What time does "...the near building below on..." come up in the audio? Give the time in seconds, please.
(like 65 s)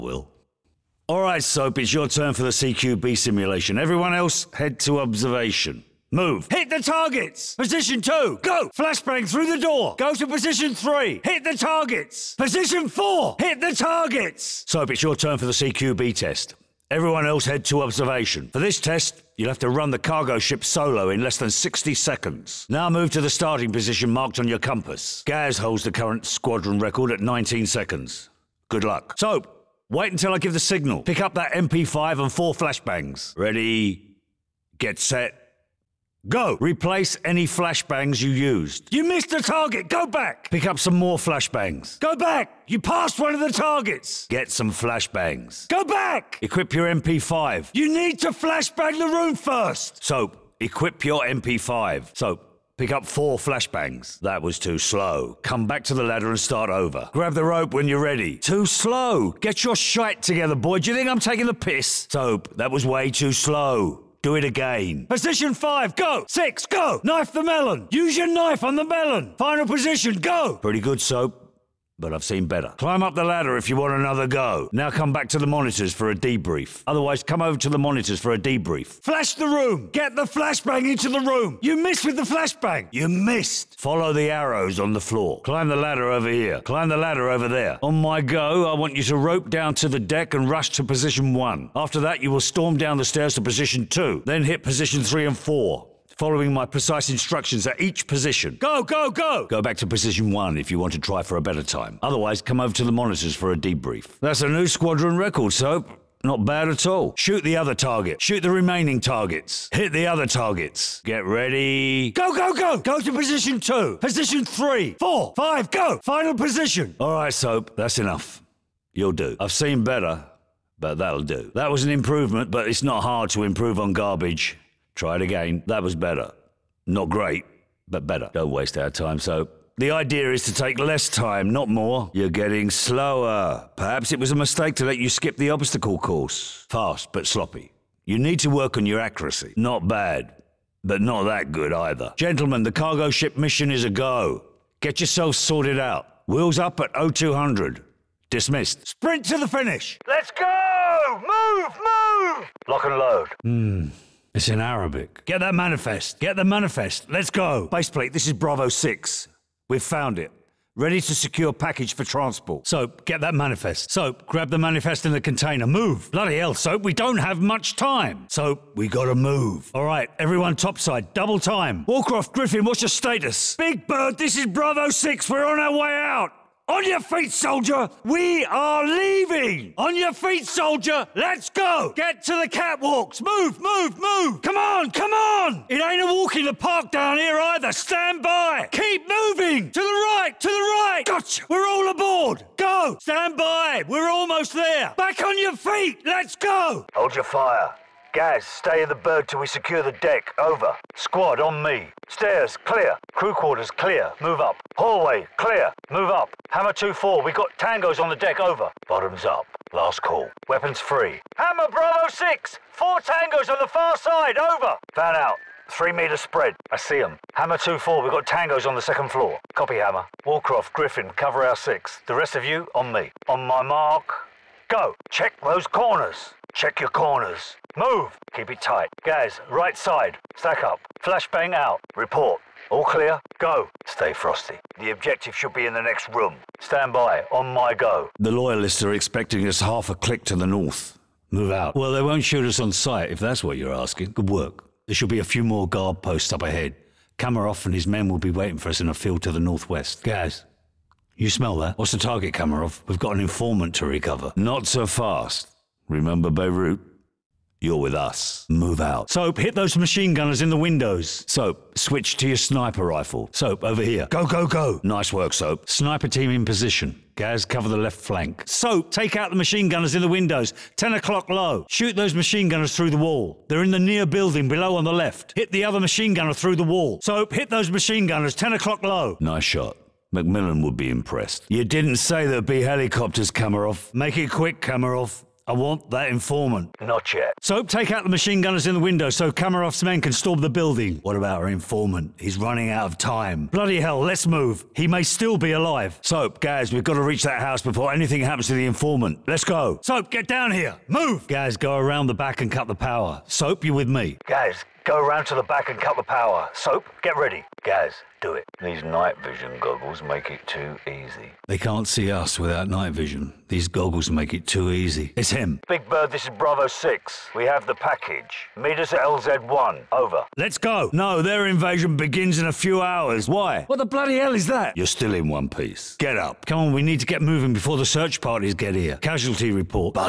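273 s.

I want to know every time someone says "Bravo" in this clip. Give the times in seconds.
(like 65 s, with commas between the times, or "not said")
158 s, 174 s, 211 s, 316 s.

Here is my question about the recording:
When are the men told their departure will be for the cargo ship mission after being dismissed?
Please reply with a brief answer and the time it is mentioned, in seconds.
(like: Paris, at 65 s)
0200, at 146 s.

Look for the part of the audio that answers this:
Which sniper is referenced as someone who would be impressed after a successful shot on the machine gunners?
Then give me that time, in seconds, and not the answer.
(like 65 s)
280 s.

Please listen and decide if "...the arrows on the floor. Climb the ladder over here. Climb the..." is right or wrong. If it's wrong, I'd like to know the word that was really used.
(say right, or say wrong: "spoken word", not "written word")
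right.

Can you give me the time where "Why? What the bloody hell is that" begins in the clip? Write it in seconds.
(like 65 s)
323 s.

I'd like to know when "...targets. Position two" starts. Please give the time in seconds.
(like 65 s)
6 s.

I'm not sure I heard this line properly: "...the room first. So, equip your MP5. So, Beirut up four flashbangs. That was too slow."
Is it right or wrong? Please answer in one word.
wrong.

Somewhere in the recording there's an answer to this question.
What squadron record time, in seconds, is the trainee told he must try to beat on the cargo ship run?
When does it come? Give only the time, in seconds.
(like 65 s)
27 s.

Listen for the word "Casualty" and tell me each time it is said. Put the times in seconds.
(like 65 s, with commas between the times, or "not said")
328 s.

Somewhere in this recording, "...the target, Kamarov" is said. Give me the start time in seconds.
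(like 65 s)
251 s.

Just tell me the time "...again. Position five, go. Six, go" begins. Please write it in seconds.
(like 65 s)
64 s.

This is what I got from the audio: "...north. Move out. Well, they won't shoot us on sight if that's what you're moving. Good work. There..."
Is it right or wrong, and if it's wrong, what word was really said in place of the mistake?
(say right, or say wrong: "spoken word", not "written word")
wrong: "asking", not "moving".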